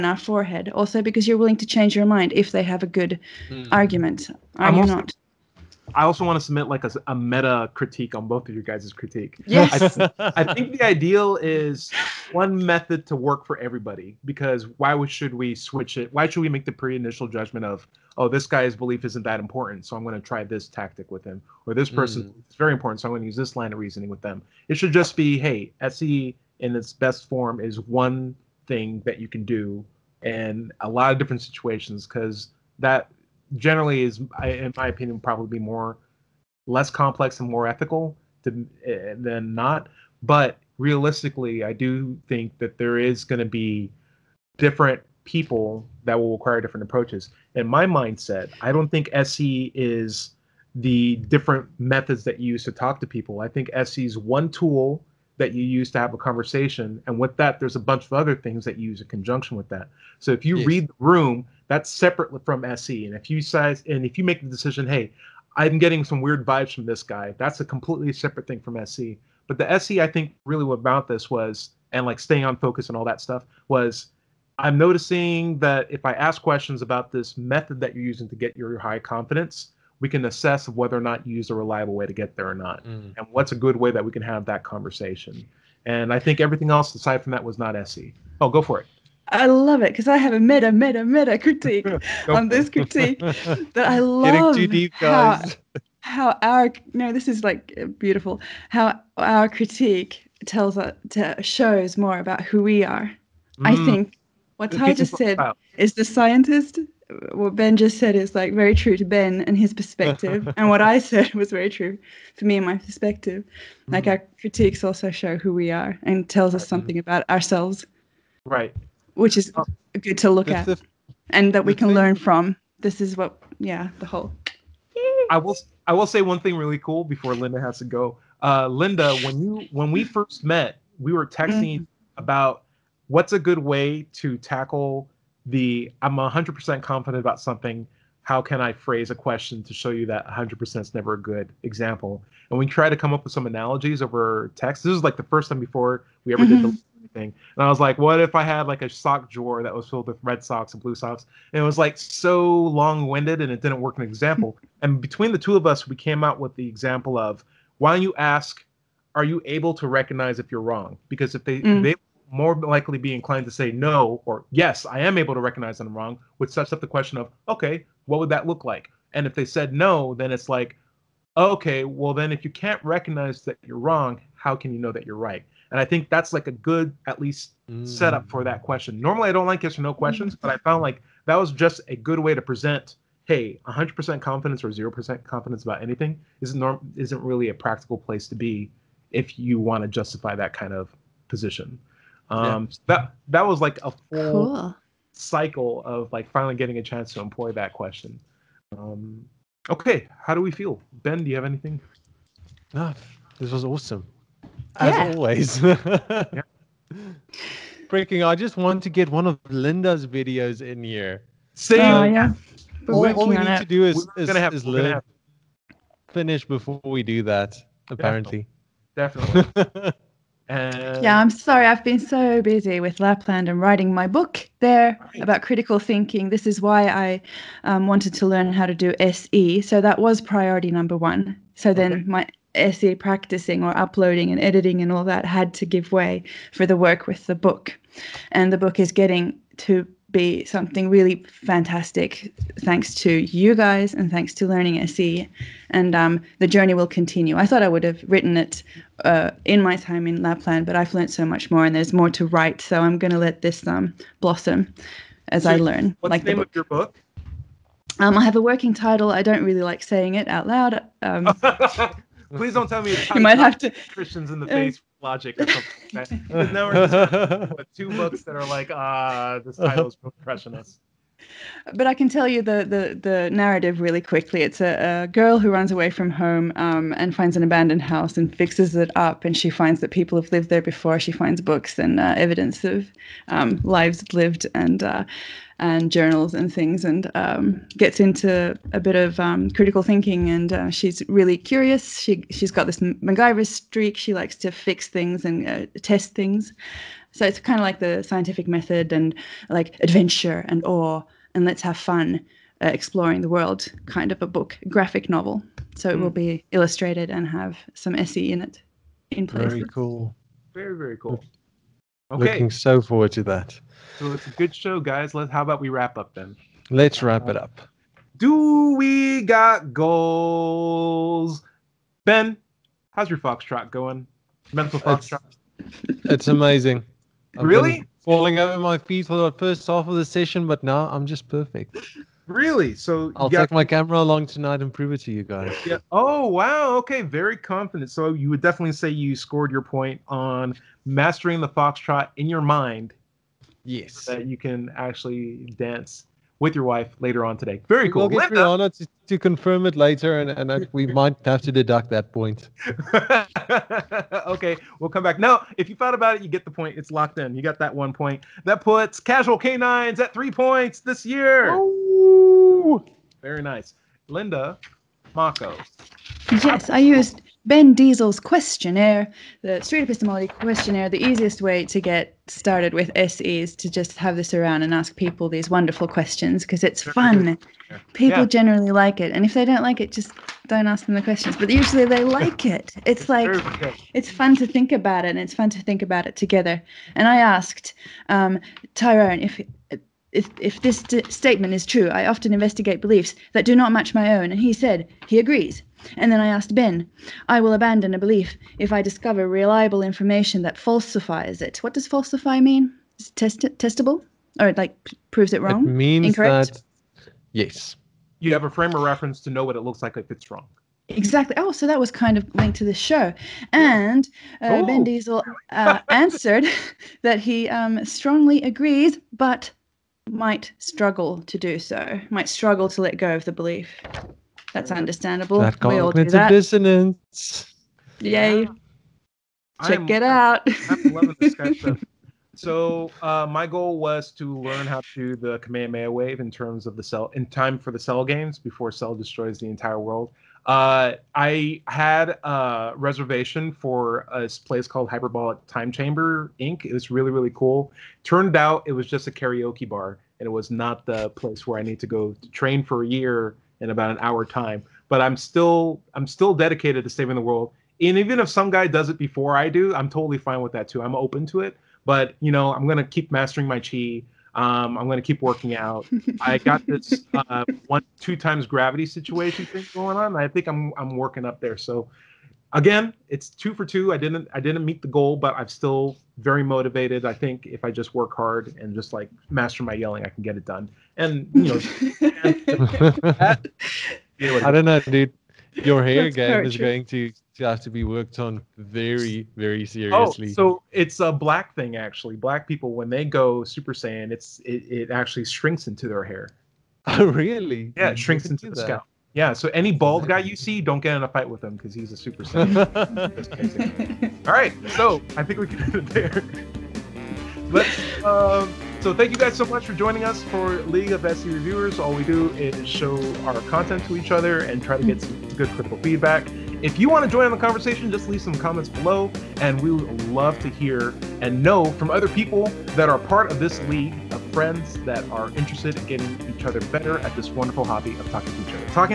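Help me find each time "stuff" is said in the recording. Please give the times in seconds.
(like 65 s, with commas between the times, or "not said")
73 s, 431 s.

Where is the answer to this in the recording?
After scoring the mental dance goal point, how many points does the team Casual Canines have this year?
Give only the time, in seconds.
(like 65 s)
360 s.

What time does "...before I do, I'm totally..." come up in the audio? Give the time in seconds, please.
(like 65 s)
458 s.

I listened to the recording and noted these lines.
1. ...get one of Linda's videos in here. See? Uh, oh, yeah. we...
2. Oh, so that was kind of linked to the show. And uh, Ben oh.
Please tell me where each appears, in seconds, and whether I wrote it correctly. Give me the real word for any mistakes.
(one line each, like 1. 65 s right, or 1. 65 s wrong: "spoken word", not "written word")
1. 208 s right
2. 411 s right.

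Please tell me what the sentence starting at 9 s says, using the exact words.
I, I, think the ideal is one method to work for everybody because why would, should we switch it?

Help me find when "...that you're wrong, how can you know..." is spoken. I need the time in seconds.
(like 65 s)
173 s.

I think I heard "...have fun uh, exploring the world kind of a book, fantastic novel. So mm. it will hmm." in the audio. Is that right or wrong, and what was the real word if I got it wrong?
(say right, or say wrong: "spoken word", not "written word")
wrong: "graphic", not "fantastic".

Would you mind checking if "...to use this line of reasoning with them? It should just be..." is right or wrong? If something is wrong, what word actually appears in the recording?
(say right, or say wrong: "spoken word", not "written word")
right.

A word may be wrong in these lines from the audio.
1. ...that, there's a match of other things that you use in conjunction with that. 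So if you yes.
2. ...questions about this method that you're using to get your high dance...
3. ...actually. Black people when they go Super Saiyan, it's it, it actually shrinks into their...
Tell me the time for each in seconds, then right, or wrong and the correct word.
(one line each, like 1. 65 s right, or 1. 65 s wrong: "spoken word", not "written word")
1. 57 s wrong: "bunch", not "match"
2. 76 s wrong: "confidence", not "dance"
3. 491 s right.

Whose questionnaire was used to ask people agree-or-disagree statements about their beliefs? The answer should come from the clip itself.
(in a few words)
Ben Diesel.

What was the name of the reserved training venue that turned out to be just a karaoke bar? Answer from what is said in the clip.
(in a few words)
Hyperbolic Time Chamber Inc.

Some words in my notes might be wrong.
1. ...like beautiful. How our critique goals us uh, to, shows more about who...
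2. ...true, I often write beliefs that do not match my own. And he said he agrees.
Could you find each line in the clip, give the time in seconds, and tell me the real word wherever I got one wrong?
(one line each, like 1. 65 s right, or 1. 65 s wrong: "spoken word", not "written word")
1. 97 s wrong: "tells", not "goals"
2. 391 s wrong: "investigate", not "write".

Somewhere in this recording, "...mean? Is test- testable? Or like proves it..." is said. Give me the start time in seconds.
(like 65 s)
402 s.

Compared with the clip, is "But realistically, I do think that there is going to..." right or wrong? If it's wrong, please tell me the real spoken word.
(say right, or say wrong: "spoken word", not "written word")
right.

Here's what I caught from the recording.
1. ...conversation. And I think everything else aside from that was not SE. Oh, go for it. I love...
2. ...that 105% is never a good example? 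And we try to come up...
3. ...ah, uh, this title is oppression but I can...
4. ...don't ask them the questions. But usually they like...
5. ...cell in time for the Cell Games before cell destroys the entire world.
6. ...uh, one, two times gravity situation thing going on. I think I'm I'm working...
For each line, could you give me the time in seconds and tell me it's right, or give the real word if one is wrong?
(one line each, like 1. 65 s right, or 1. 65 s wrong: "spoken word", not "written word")
1. 84 s right
2. 140 s wrong: "100", not "105"
3. 268 s right
4. 380 s right
5. 436 s right
6. 467 s right.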